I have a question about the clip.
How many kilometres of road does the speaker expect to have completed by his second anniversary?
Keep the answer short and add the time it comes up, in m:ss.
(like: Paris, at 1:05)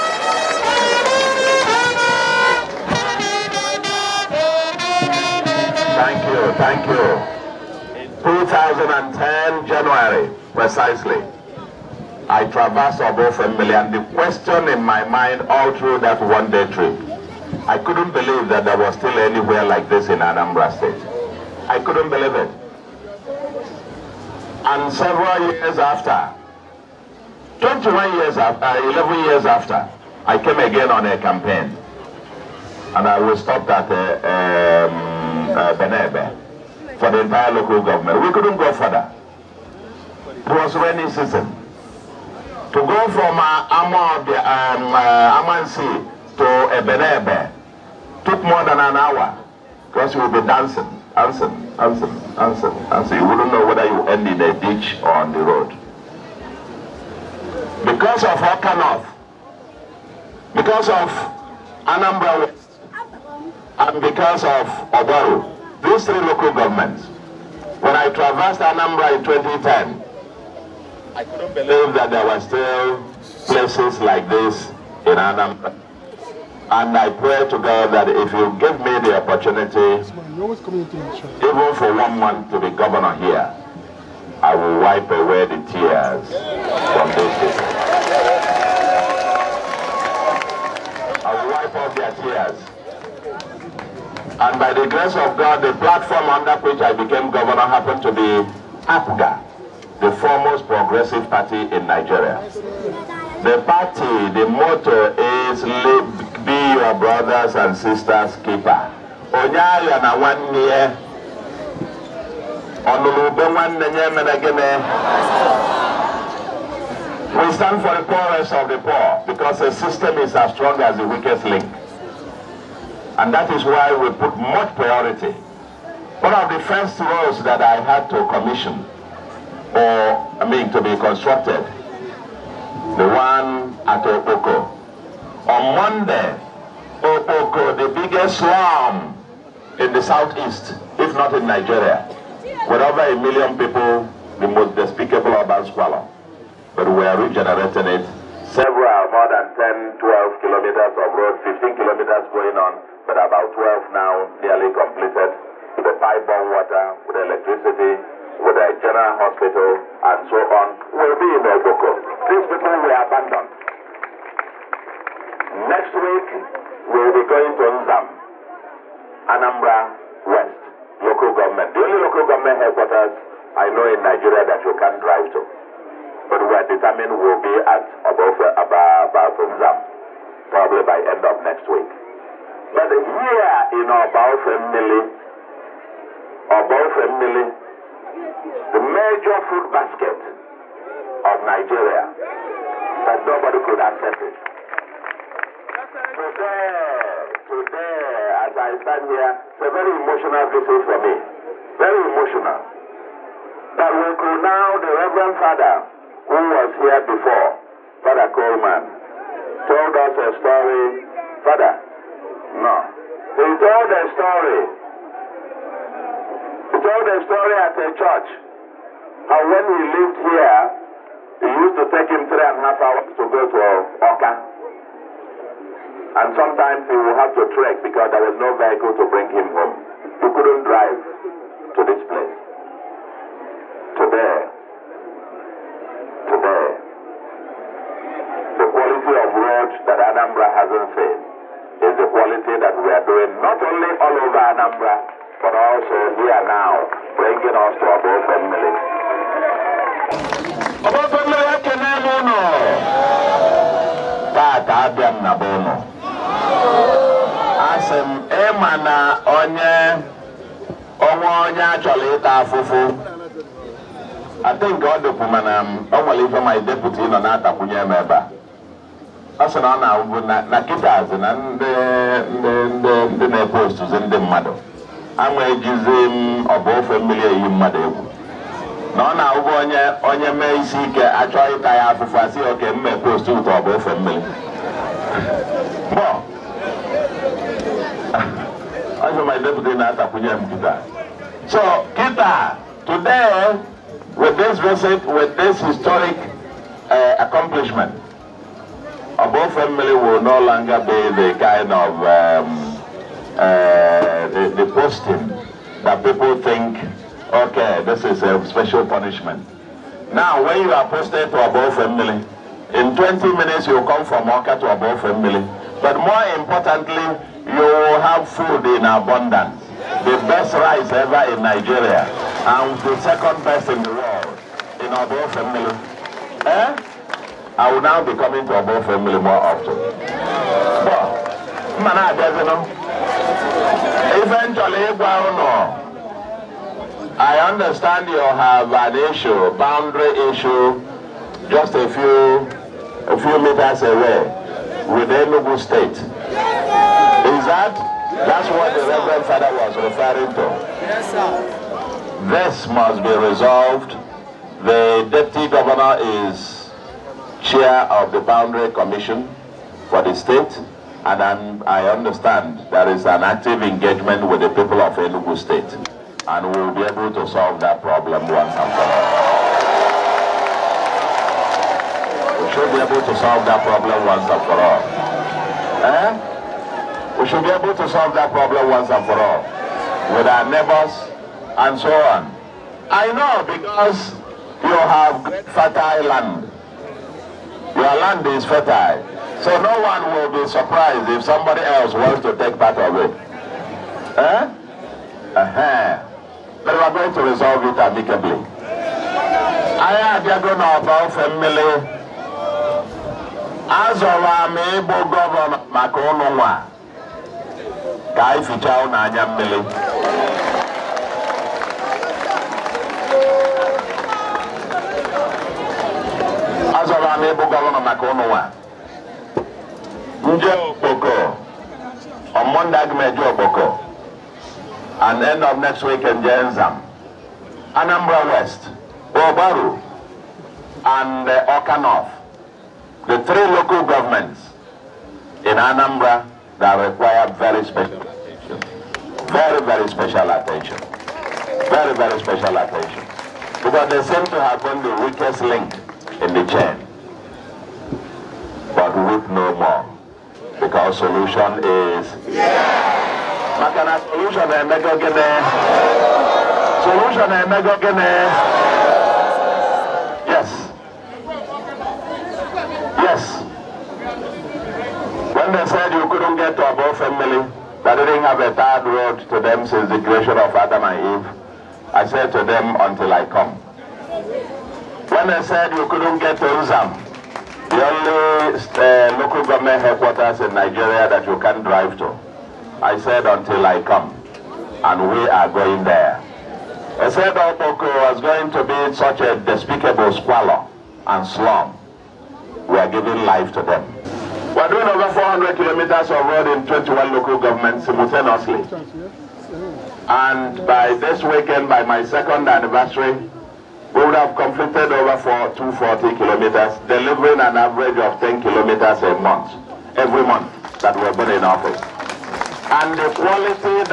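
240, at 8:25.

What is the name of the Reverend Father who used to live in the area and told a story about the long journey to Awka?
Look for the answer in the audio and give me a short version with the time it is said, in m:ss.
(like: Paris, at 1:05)
Father Coleman, at 3:28.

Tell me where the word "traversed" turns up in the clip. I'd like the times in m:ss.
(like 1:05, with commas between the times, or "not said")
0:12, 1:08.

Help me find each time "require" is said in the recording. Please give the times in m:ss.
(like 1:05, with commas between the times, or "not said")
7:16.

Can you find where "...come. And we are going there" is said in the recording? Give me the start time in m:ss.
8:03.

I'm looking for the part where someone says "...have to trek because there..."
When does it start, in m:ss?
3:47.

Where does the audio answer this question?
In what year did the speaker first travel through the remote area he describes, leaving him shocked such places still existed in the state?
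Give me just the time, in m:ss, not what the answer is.
0:08.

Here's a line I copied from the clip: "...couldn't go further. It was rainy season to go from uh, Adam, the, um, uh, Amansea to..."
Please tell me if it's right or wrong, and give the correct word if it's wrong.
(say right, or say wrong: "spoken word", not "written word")
wrong: "Amor", not "Adam".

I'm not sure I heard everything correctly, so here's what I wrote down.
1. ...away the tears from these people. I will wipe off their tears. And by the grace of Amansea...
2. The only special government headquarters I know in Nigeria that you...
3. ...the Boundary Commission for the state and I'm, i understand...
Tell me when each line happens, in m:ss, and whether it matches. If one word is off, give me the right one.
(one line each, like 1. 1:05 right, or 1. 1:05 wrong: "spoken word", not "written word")
1. 1:25 wrong: "God", not "Amansea"
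2. 2:51 wrong: "local", not "special"
3. 5:58 right.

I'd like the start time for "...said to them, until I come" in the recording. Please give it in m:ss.
7:52.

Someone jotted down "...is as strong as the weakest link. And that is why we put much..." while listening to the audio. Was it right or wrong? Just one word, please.
right.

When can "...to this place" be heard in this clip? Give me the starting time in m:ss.
3:51.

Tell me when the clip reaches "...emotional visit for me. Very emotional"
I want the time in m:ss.
3:19.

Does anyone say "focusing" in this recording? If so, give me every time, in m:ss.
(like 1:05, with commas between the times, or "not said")
not said.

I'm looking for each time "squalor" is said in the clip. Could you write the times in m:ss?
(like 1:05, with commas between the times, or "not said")
2:25, 8:10.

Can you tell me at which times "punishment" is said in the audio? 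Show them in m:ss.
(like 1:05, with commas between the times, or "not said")
5:08.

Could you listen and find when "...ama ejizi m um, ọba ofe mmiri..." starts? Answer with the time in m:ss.
4:35.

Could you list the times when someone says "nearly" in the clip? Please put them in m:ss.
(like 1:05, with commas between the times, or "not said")
2:34.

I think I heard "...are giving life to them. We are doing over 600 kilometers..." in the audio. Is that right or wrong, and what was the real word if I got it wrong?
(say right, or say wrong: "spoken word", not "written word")
wrong: "400", not "600".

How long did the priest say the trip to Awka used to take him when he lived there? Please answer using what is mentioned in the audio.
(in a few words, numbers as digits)
3 and a half hours.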